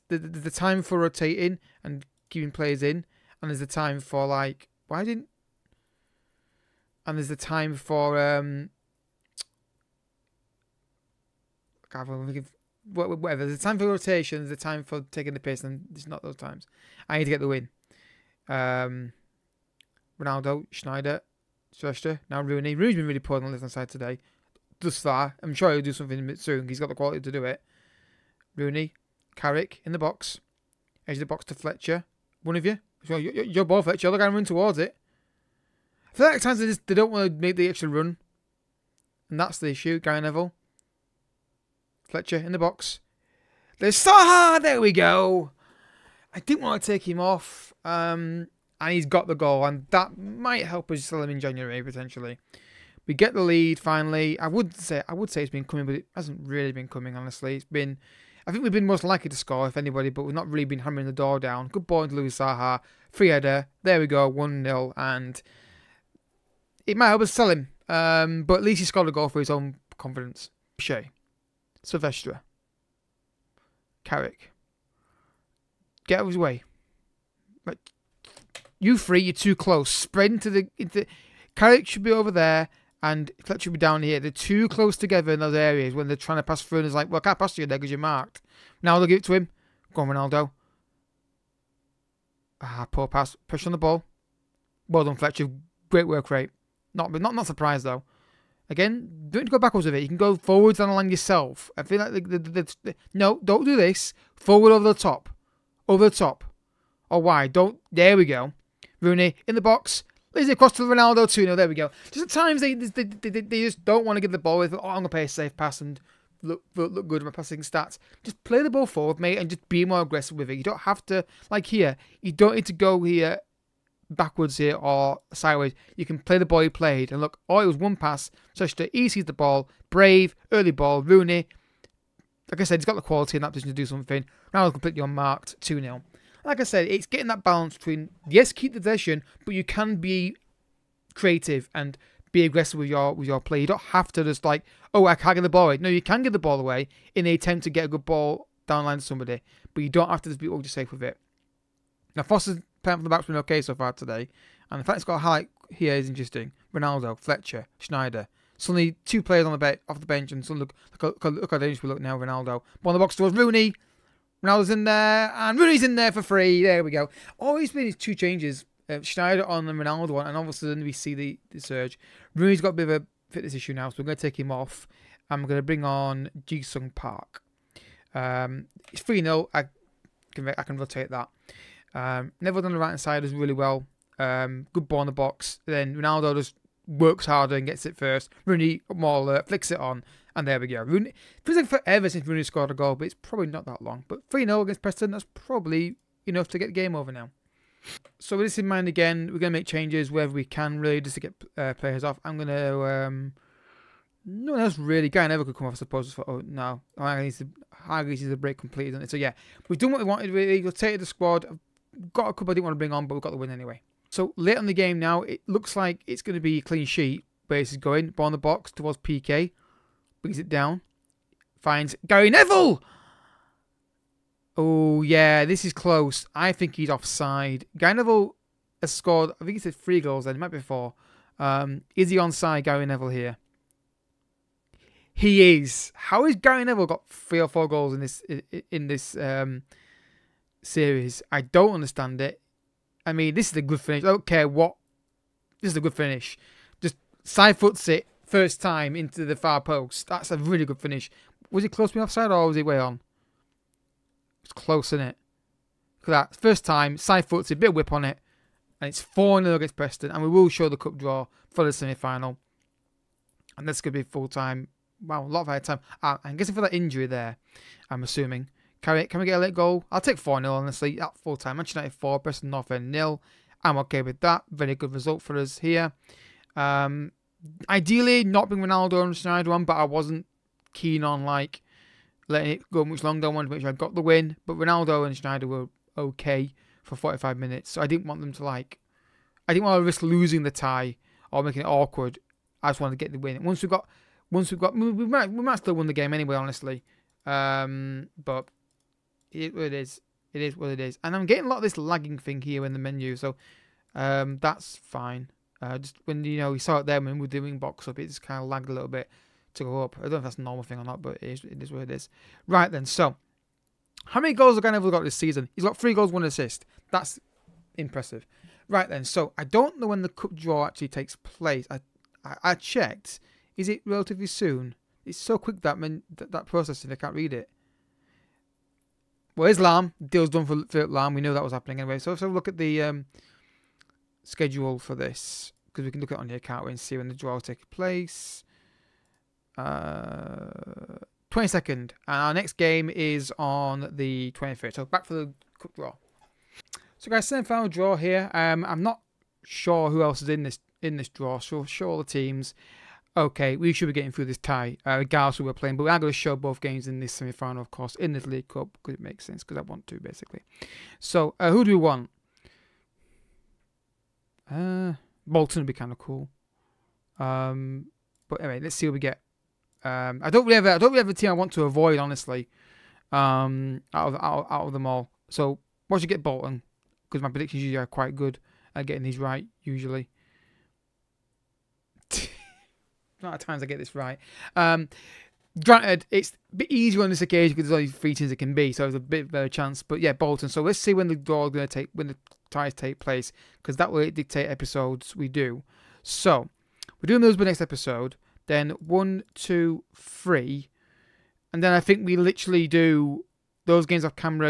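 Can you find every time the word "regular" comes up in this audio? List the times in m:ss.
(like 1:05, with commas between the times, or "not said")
not said.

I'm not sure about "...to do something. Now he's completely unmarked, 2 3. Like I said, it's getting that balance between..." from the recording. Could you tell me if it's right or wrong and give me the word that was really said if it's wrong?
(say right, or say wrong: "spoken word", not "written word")
wrong: "0", not "3".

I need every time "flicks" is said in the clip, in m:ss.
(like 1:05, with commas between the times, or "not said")
3:09.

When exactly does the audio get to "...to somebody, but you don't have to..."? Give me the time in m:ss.
2:28.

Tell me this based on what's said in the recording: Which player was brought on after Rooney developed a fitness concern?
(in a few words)
Jisung Park.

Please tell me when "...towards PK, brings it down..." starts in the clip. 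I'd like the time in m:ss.
3:38.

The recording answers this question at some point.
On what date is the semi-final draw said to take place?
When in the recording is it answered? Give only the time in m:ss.
5:41.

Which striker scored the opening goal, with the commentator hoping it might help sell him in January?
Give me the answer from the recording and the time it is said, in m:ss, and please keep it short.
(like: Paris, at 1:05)
Louis Saha, at 1:02.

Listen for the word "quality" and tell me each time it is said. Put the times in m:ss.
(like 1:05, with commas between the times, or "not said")
0:26, 2:13.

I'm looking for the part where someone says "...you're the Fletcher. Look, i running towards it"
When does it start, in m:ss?
0:33.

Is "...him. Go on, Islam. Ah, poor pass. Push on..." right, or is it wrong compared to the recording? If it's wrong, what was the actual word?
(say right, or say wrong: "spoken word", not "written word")
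wrong: "Ronaldo", not "Islam".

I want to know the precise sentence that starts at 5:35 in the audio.
Because we can look at it on here, can't we?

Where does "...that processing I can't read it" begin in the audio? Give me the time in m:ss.
5:26.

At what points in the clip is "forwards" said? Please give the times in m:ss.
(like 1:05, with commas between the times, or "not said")
1:40, 1:44, 1:58.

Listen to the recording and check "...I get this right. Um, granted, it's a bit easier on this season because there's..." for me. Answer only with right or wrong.
wrong.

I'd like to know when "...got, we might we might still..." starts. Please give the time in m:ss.
4:54.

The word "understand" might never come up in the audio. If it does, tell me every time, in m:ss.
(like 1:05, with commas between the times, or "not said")
4:01.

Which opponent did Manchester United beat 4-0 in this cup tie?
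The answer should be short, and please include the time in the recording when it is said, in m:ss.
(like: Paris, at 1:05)
Preston North End, at 4:32.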